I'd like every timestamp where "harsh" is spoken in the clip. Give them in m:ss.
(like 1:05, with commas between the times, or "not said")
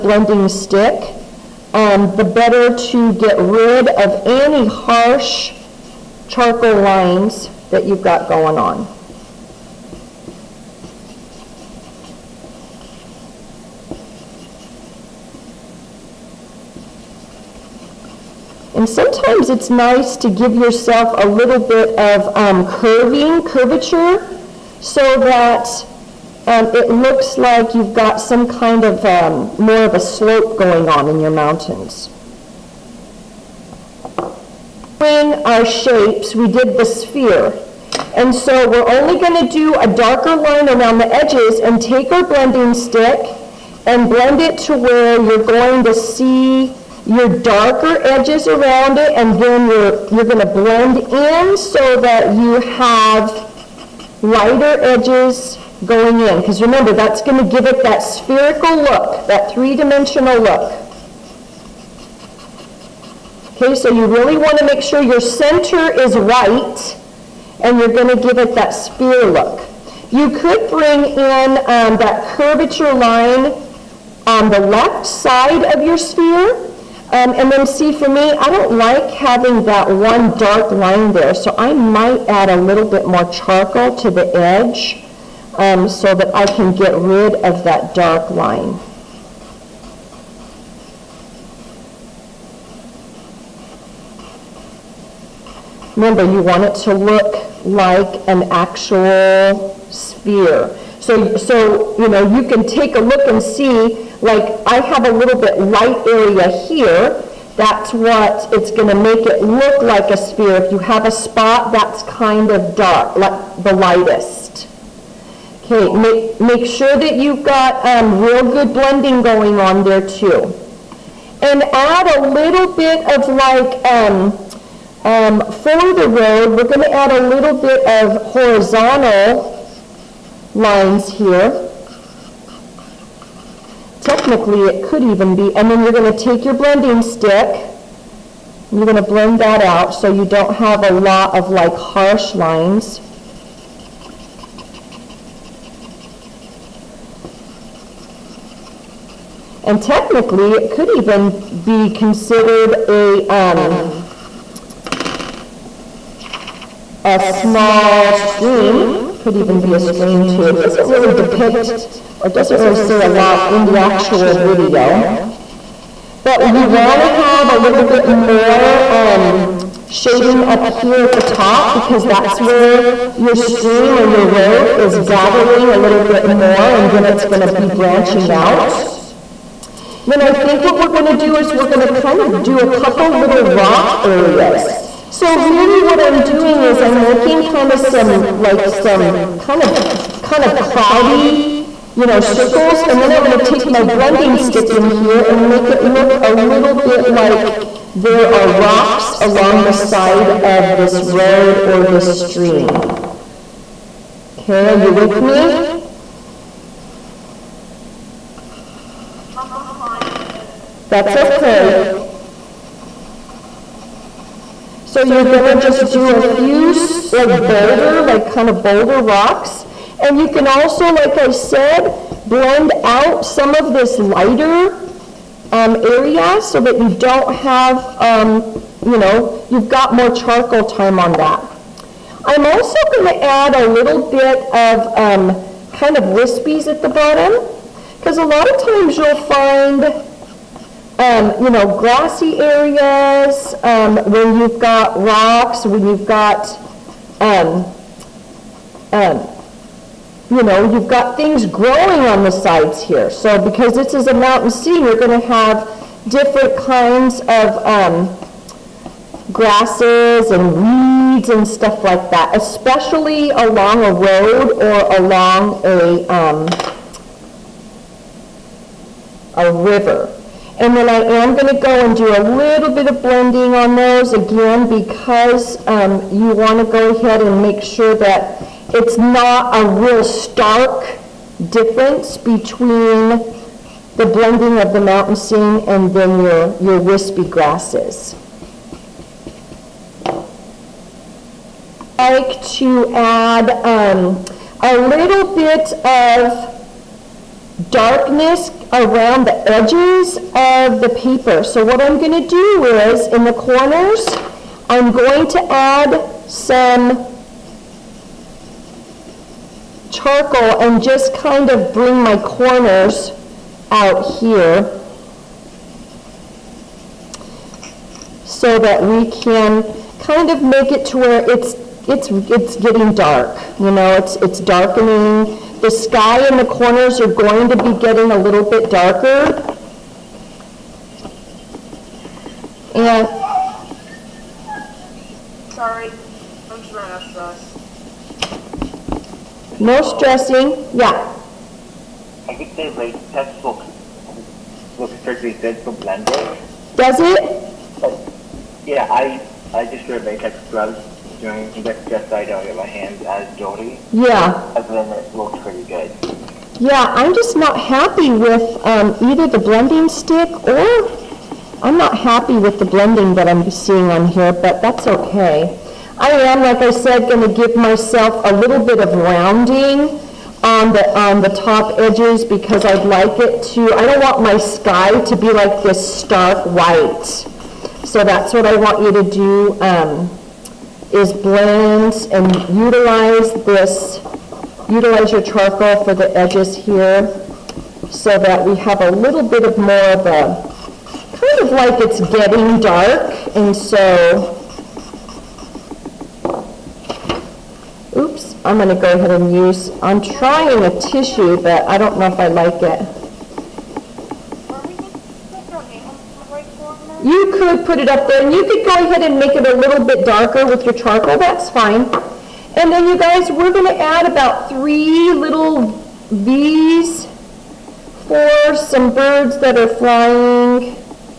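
0:04, 2:21.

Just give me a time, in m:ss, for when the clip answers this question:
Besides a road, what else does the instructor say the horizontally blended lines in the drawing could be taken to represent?
2:37.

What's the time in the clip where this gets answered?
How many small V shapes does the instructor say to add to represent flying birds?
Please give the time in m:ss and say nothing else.
6:54.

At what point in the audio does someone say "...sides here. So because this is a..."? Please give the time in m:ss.
4:12.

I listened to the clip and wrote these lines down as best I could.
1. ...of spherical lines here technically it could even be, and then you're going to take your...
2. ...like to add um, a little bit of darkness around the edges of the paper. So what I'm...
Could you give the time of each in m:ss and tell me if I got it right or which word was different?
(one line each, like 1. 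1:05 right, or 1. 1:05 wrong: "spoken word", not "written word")
1. 2:08 wrong: "horizontal", not "spherical"
2. 4:52 right.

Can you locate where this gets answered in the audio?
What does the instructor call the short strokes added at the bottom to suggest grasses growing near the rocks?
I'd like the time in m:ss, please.
3:56.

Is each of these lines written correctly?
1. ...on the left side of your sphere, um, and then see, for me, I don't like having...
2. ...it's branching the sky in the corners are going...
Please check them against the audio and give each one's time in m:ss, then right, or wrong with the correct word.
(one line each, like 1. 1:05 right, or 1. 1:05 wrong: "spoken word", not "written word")
1. 1:14 right
2. 5:24 wrong: "darkening", not "branching".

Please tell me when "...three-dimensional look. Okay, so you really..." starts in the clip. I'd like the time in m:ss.
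0:59.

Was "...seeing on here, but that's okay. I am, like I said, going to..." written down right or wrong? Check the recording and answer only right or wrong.
right.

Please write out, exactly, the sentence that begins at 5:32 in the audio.
And sorry, I'm just running out of sauce.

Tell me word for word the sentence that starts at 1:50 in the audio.
If you have a spot that's kind of dark, like the lightest.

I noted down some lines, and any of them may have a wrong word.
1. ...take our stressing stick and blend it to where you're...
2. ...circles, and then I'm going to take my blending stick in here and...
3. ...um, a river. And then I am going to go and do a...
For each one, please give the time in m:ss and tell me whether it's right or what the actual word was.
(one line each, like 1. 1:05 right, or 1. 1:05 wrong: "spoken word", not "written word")
1. 0:41 wrong: "blending", not "stressing"
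2. 3:12 right
3. 4:26 right.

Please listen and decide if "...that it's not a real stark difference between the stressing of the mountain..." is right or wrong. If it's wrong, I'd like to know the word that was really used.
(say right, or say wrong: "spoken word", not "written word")
wrong: "blending", not "stressing".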